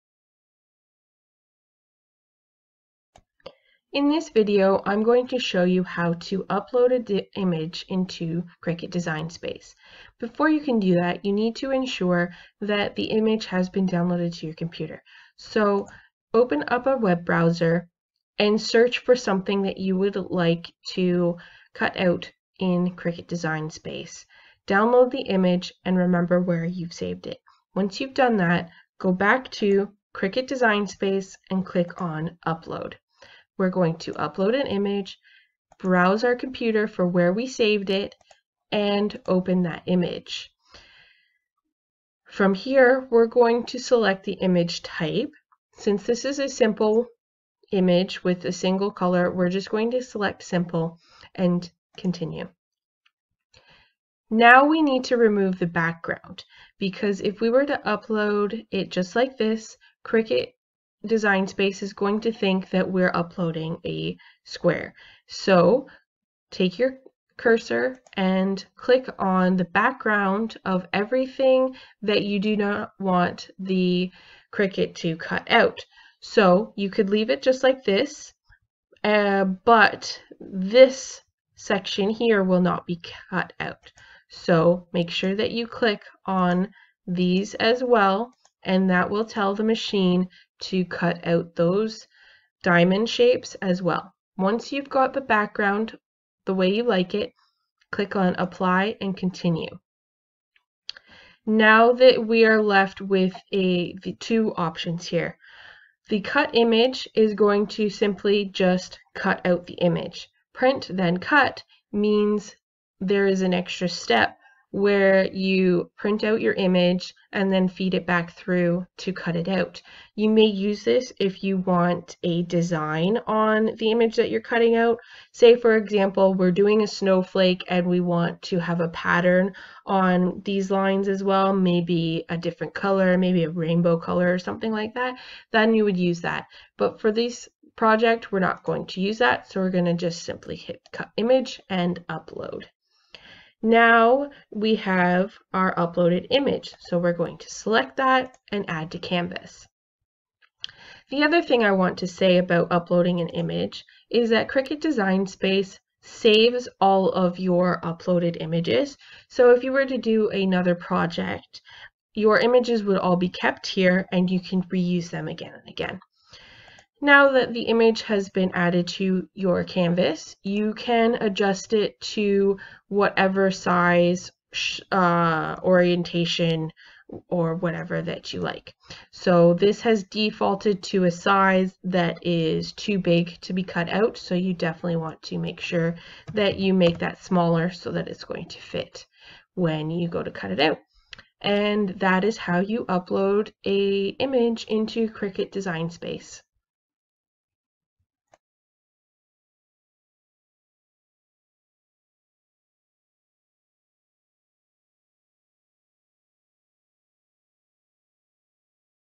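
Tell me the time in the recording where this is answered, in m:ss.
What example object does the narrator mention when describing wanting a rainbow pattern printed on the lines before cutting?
2:06.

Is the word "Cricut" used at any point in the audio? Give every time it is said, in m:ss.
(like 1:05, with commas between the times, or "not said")
0:08, 0:22, 0:30, 1:00, 1:14, 2:34, 3:15.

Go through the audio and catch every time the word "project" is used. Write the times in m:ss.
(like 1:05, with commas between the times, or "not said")
2:17, 2:40.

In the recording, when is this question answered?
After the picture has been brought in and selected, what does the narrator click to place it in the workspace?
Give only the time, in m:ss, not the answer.
2:28.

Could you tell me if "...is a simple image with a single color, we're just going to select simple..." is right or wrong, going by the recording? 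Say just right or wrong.
right.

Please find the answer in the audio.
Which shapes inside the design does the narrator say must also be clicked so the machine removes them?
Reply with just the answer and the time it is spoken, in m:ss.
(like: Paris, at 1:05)
Diamond shapes, at 1:32.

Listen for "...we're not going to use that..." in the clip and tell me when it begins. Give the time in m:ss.
2:18.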